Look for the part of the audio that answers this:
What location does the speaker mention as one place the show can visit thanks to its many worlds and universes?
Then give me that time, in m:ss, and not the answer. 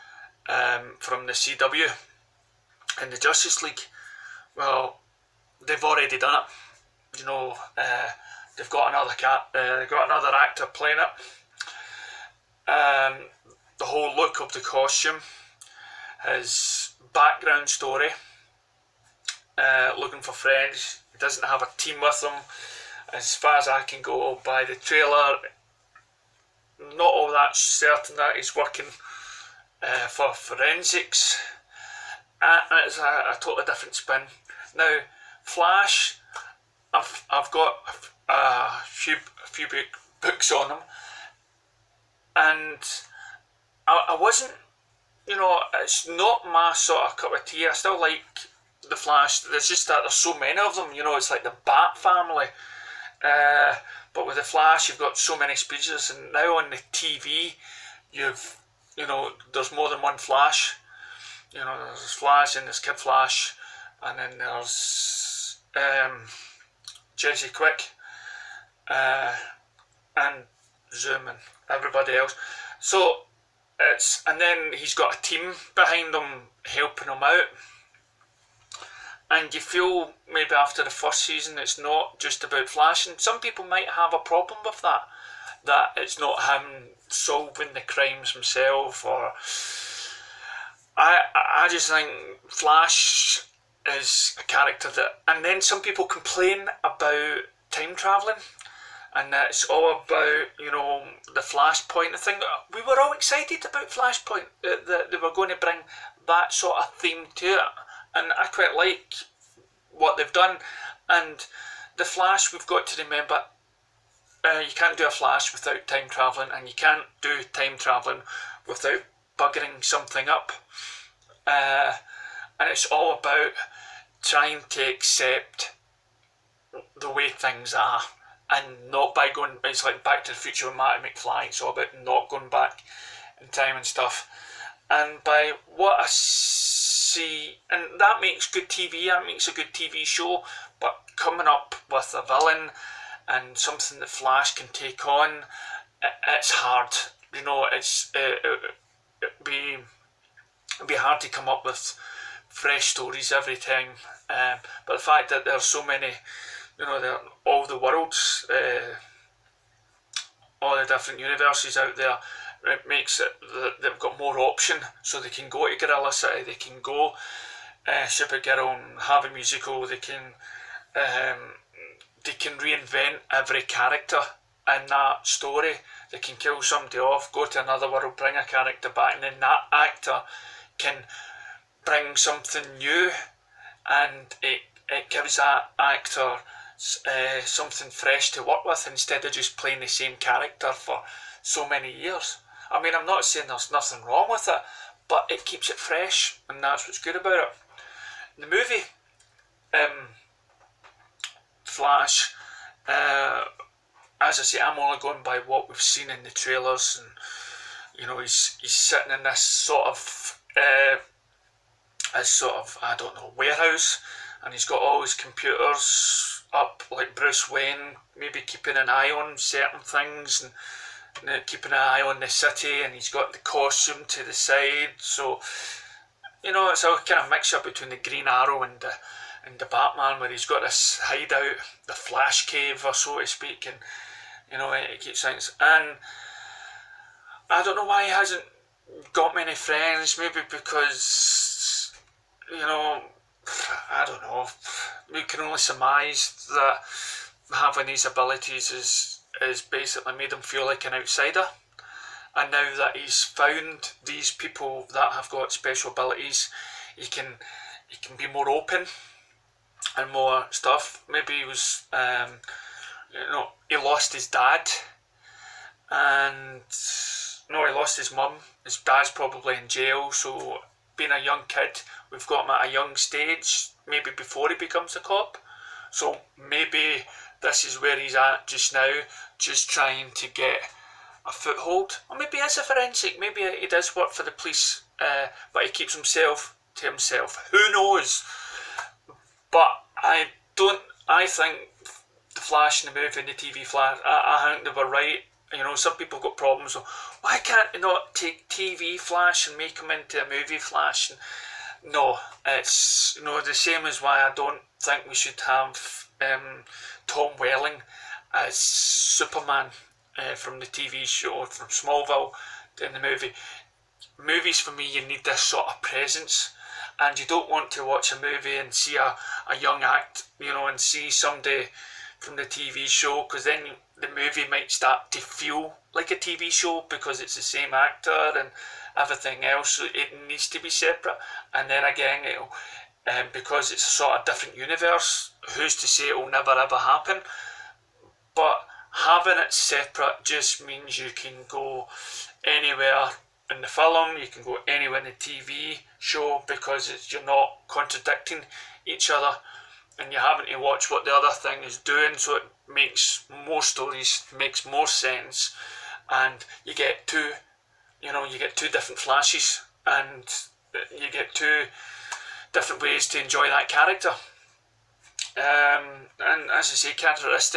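2:45.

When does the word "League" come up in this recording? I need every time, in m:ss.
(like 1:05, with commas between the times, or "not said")
0:03.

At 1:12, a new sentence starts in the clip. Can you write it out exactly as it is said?
So it's and then he's got a team behind him helping him out.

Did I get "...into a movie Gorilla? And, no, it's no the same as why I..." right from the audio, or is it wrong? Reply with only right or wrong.
wrong.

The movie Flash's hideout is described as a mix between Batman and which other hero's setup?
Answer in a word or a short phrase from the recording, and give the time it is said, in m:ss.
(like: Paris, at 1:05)
Green Arrow, at 3:47.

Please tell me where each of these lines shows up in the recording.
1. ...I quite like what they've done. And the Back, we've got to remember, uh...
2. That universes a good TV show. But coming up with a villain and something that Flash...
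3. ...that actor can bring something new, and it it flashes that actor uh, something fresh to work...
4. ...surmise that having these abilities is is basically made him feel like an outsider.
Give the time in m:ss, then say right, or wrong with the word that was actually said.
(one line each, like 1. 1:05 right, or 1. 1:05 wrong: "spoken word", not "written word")
1. 1:48 wrong: "Flash", not "Back"
2. 2:19 wrong: "makes", not "universes"
3. 2:59 wrong: "gives", not "flashes"
4. 4:05 right.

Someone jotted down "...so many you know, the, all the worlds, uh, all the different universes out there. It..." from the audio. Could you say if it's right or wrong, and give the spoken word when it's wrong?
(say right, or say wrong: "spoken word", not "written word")
right.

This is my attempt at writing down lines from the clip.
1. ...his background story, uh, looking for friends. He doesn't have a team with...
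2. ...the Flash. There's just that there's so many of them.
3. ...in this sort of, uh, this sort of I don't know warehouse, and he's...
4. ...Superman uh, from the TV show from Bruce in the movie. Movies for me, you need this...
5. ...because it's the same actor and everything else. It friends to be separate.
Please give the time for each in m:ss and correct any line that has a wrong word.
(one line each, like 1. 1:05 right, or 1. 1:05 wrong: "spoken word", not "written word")
1. 0:16 right
2. 0:48 right
3. 3:29 right
4. 5:08 wrong: "Smallville", not "Bruce"
5. 5:26 wrong: "needs", not "friends".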